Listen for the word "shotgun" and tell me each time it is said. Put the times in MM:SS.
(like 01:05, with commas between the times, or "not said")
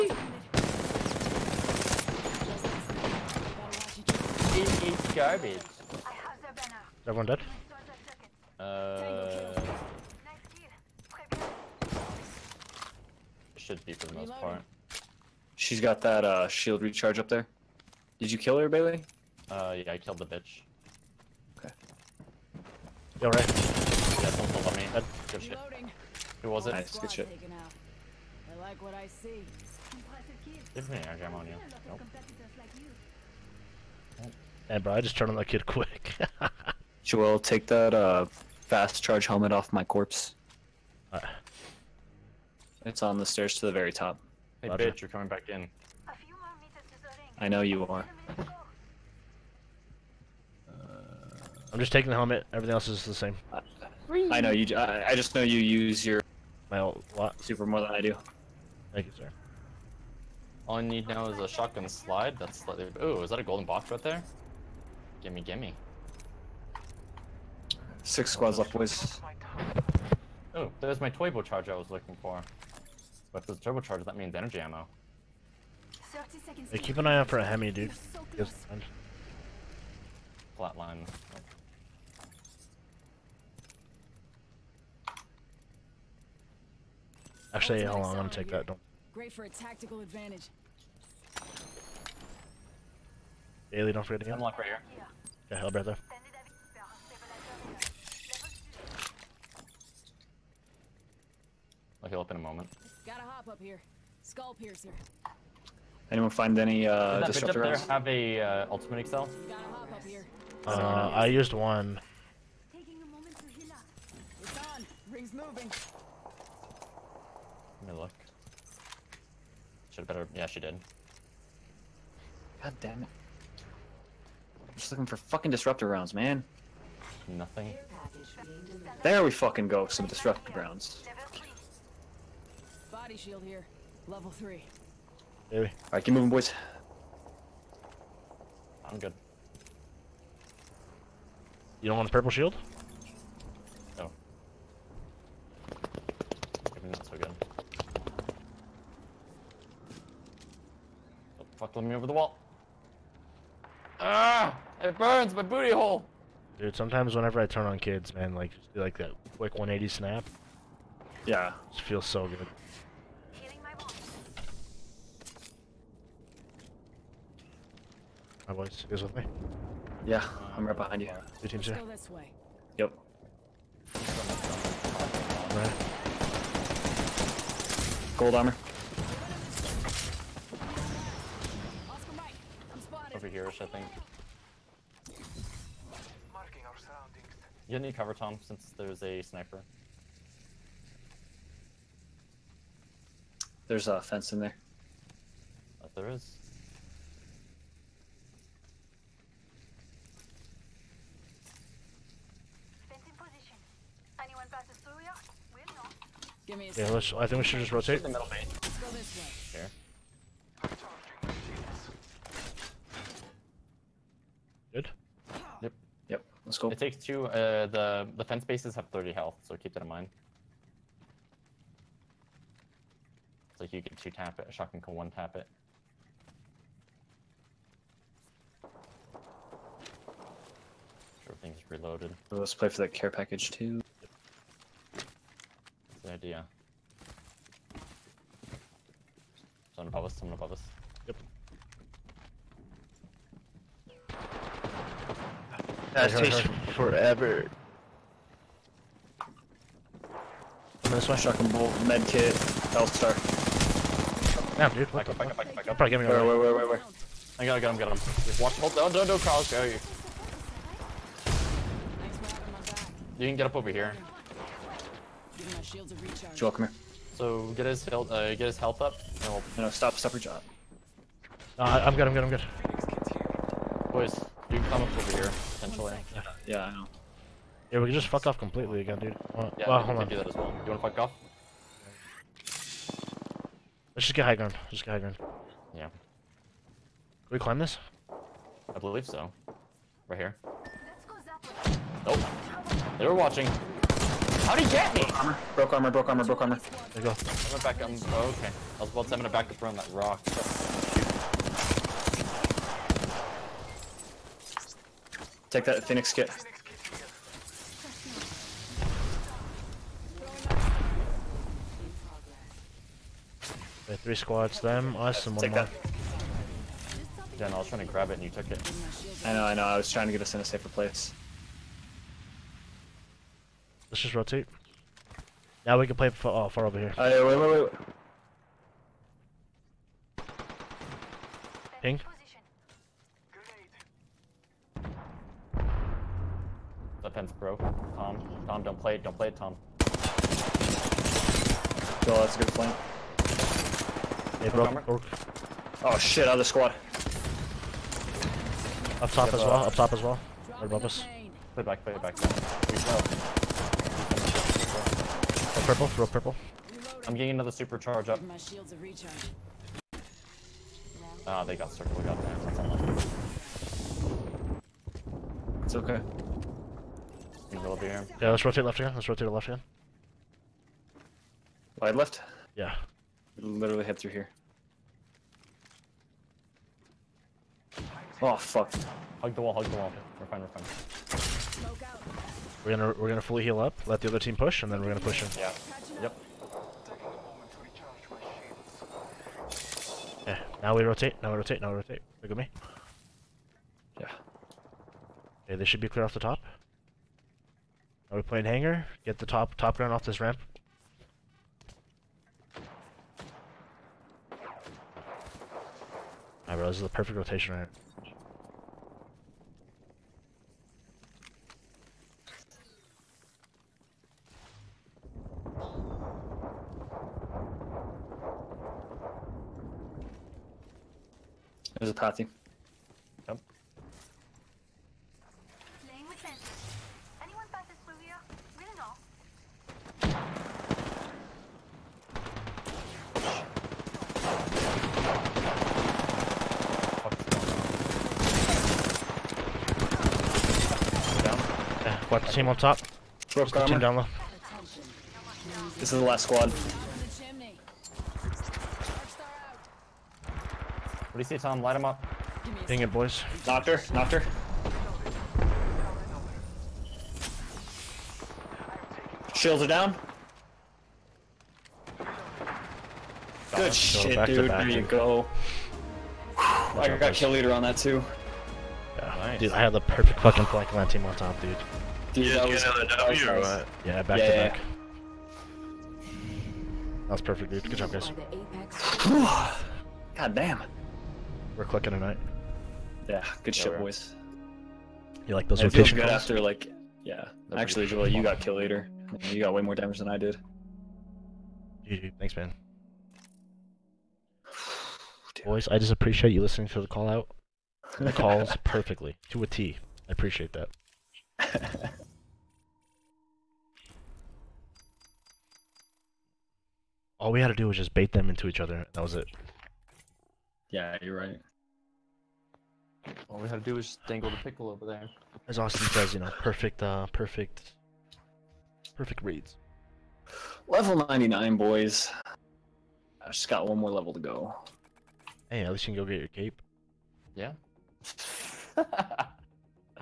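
01:01, 03:44, 04:11.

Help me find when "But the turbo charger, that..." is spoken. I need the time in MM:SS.
01:13.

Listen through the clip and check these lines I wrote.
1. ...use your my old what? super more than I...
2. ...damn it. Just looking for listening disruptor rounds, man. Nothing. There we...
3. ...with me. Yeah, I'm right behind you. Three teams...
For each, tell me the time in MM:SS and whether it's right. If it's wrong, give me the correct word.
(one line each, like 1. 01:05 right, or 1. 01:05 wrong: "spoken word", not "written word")
1. 00:55 right
2. 02:02 wrong: "fucking", not "listening"
3. 02:49 wrong: "Two", not "Three".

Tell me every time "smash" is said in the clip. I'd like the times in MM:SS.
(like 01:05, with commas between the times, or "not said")
04:10.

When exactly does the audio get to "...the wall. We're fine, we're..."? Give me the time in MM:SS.
06:19.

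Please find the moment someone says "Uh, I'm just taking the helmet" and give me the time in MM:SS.
00:50.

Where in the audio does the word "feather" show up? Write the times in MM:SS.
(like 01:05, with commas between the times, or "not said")
not said.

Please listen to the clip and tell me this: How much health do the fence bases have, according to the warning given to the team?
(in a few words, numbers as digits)
30.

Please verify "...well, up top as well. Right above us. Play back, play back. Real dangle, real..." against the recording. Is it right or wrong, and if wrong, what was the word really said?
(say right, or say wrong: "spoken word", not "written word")
wrong: "purple", not "dangle".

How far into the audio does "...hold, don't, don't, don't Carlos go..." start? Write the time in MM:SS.
04:18.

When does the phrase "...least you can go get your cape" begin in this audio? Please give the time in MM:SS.
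08:45.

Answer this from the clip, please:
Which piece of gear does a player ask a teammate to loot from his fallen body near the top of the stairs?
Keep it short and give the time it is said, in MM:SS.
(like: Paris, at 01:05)
Fast charge helmet, at 00:38.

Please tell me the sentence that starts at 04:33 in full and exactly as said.
Boys, you can come up over here, potentially.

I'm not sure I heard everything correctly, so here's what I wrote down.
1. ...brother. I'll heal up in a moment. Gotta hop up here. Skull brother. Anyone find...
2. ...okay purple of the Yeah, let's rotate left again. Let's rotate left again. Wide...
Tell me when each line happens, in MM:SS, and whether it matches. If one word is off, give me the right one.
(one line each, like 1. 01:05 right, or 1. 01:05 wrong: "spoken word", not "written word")
1. 01:35 wrong: "piercer", not "brother"
2. 06:05 wrong: "middle", not "purple".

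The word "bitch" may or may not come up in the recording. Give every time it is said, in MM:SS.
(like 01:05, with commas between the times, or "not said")
00:20, 00:44.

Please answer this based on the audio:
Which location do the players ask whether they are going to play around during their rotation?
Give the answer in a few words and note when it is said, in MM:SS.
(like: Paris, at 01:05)
Hangar, at 06:38.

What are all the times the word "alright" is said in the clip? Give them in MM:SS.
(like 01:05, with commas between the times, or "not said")
00:23, 02:15, 06:46.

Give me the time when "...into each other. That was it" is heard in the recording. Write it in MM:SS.
08:28.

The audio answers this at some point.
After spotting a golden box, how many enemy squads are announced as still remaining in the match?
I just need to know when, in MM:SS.
01:08.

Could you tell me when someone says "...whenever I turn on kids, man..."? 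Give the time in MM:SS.
02:37.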